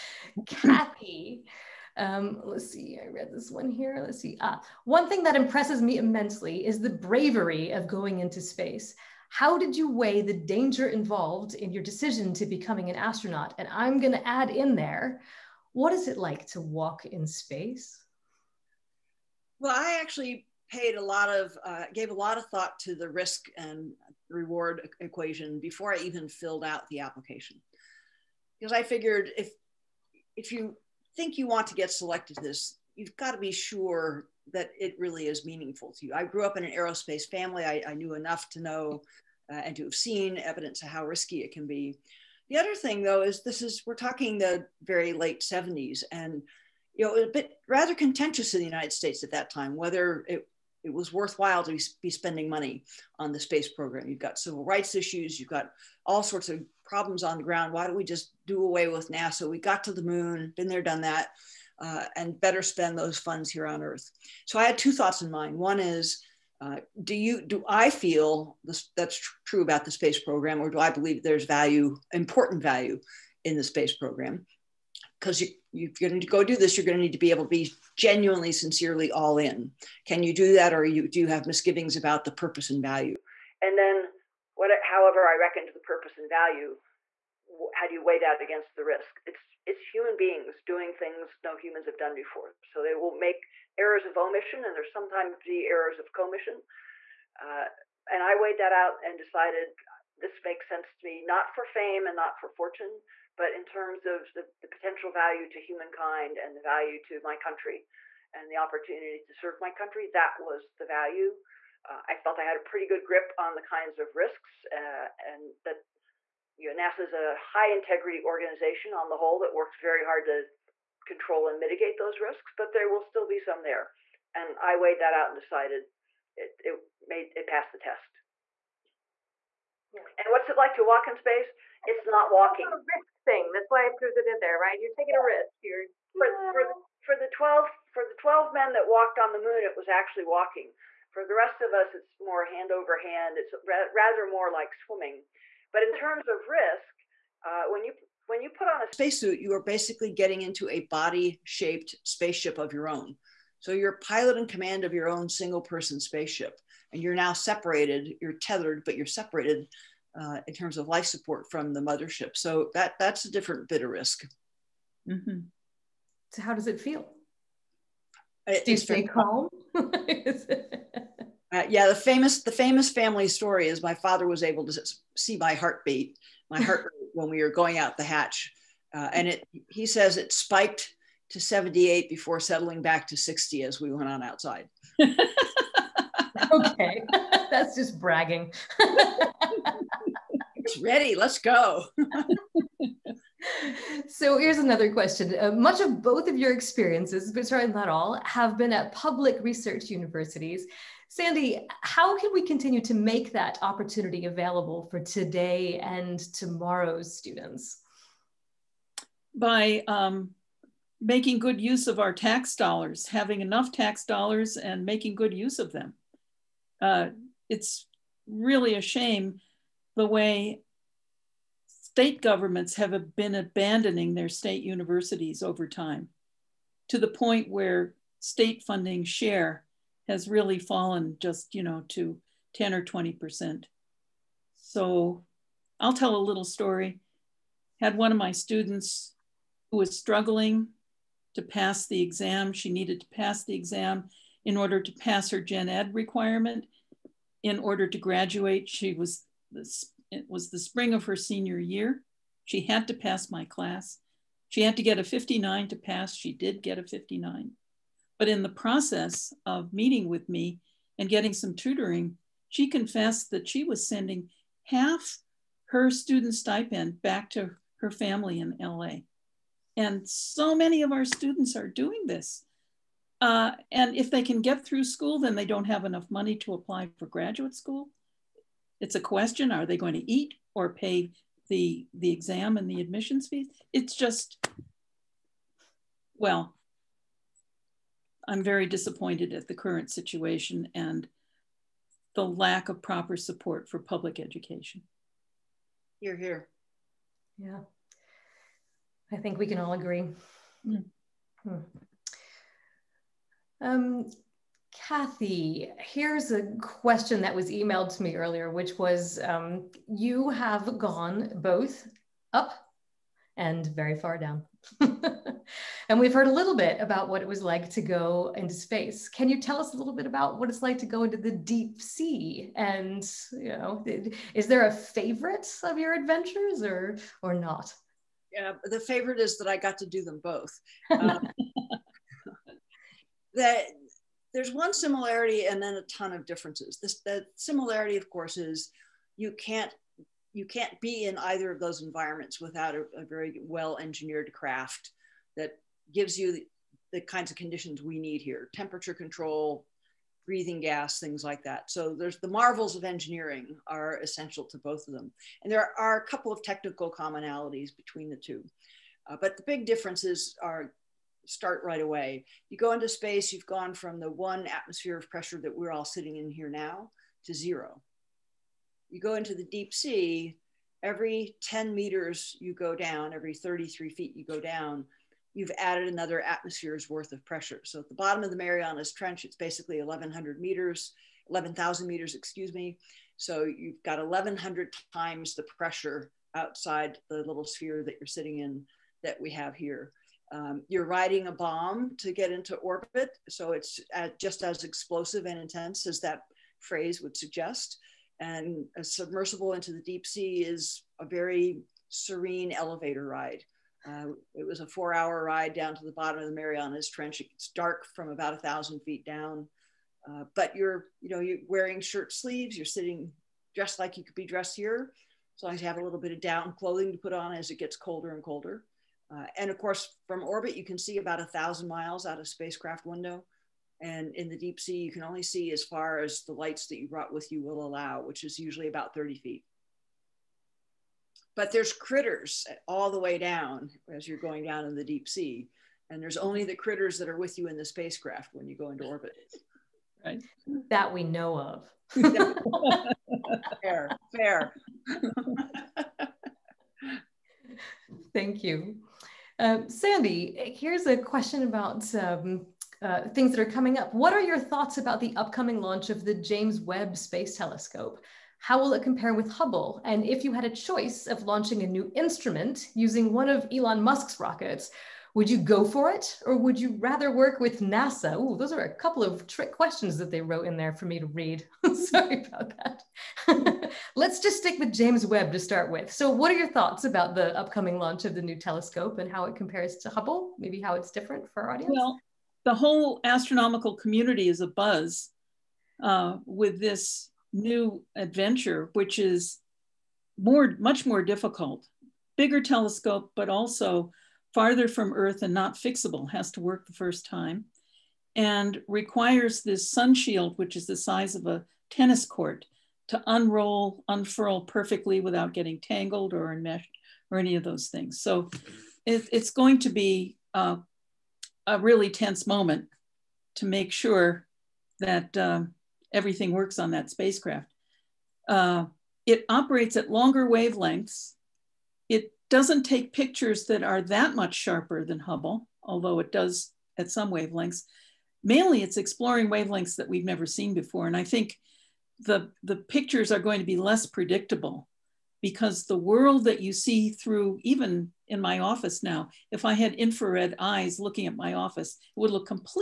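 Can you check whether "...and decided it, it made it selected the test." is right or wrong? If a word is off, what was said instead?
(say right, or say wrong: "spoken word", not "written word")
wrong: "passed", not "selected".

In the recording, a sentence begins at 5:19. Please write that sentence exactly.
Can you tell us a little bit about what it's like to go into the deep sea?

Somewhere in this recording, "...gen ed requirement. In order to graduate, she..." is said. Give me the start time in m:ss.
4:05.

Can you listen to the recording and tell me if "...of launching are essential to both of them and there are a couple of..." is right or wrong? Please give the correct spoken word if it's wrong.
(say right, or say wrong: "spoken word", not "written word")
wrong: "engineering", not "launching".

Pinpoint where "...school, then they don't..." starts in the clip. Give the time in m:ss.
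4:34.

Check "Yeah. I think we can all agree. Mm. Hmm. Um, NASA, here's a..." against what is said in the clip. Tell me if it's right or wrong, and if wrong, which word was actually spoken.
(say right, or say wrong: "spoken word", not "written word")
wrong: "Kathy", not "NASA".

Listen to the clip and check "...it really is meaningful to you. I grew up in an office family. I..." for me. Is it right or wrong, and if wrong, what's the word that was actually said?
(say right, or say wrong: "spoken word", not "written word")
wrong: "aerospace", not "office".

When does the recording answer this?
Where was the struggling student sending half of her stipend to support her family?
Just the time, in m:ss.
4:28.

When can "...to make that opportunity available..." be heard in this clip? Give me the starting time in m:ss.
3:22.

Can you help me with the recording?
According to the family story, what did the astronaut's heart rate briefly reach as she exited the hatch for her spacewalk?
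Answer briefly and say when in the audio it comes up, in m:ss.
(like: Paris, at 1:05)
78, at 3:01.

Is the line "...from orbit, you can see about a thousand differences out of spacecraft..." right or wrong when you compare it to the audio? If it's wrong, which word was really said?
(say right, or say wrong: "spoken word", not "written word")
wrong: "miles", not "differences".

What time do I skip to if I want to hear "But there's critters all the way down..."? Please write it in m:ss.
7:11.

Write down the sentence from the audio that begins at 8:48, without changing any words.
Mainly it's exploring wavelengths that we've never seen before.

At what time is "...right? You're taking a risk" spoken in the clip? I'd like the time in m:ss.
2:14.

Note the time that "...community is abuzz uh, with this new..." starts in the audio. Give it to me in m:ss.
8:03.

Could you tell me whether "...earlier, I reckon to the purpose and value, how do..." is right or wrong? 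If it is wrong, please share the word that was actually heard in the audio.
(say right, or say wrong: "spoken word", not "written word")
wrong: "however", not "earlier".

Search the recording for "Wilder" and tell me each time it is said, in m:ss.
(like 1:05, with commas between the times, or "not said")
not said.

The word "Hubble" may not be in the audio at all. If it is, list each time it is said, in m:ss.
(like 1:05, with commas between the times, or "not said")
7:39, 7:59, 8:44.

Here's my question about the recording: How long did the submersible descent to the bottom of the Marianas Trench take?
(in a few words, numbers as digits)
4 hours.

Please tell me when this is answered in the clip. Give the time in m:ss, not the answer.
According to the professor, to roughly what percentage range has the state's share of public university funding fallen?
3:52.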